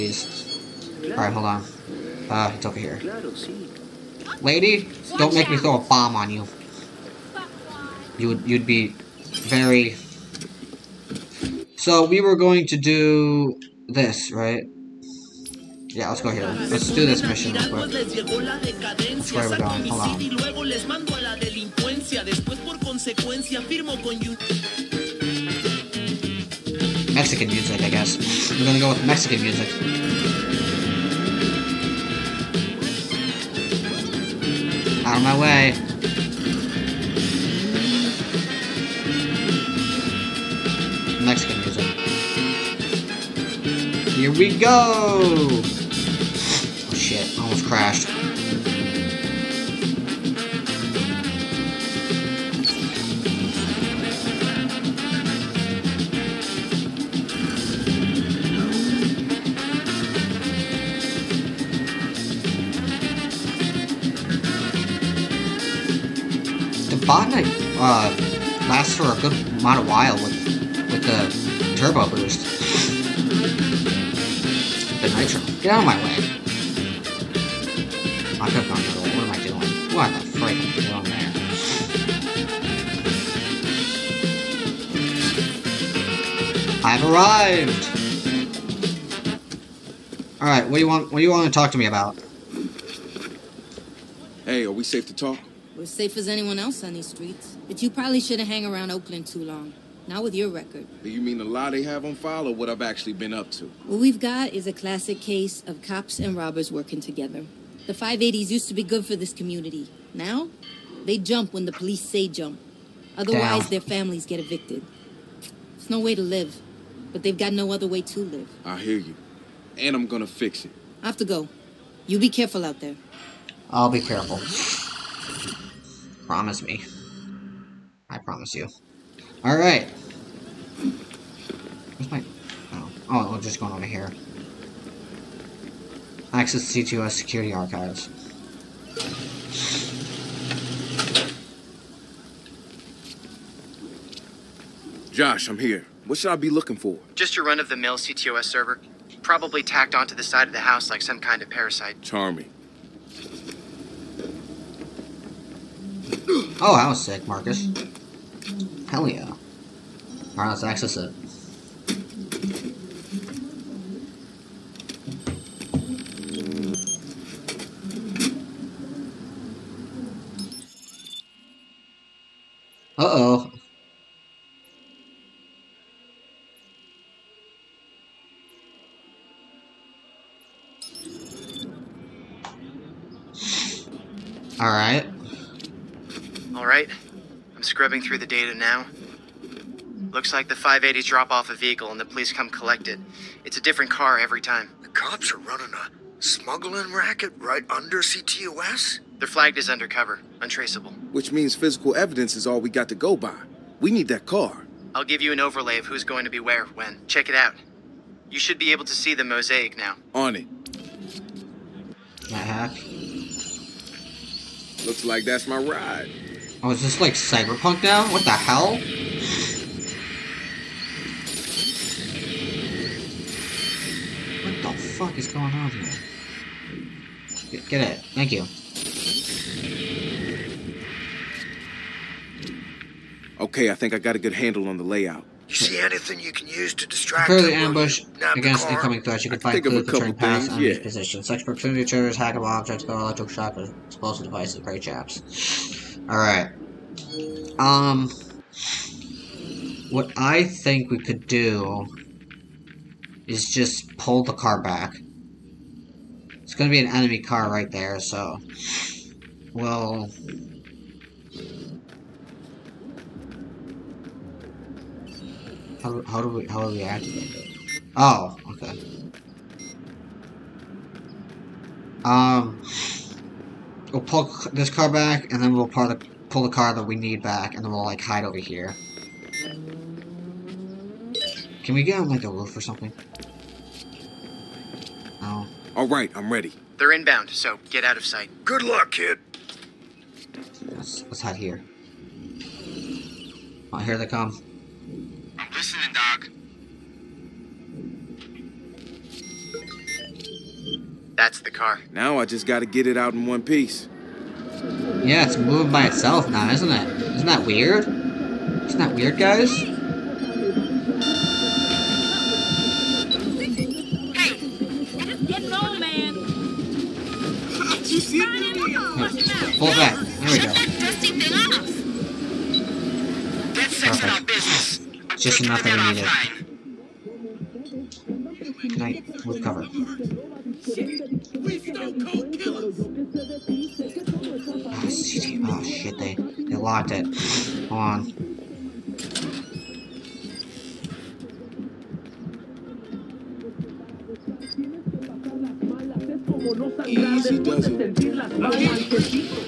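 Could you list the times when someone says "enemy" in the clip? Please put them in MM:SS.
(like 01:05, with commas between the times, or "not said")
04:00, 04:16.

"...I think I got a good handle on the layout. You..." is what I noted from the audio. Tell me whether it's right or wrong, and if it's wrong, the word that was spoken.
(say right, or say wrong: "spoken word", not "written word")
right.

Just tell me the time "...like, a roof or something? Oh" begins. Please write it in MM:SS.
04:42.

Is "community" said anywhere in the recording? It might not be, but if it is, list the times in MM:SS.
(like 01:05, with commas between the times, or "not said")
01:49.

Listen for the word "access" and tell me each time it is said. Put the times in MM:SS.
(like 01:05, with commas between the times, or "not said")
02:16, 02:40.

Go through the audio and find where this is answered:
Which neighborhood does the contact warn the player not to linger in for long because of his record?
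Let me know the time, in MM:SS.
01:38.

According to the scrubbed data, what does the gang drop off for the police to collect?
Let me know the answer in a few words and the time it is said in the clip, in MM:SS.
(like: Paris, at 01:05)
A vehicle, at 03:11.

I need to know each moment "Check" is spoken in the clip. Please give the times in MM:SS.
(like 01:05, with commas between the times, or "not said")
03:27.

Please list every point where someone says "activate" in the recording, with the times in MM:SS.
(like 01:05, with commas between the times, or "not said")
04:26.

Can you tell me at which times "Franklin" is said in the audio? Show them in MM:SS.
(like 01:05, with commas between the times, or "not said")
not said.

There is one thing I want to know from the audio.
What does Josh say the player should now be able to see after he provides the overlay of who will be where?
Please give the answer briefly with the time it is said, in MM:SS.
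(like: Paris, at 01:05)
The mosaic, at 03:29.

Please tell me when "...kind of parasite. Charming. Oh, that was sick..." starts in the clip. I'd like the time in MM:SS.
02:31.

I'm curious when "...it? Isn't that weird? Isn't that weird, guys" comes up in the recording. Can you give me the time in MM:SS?
05:06.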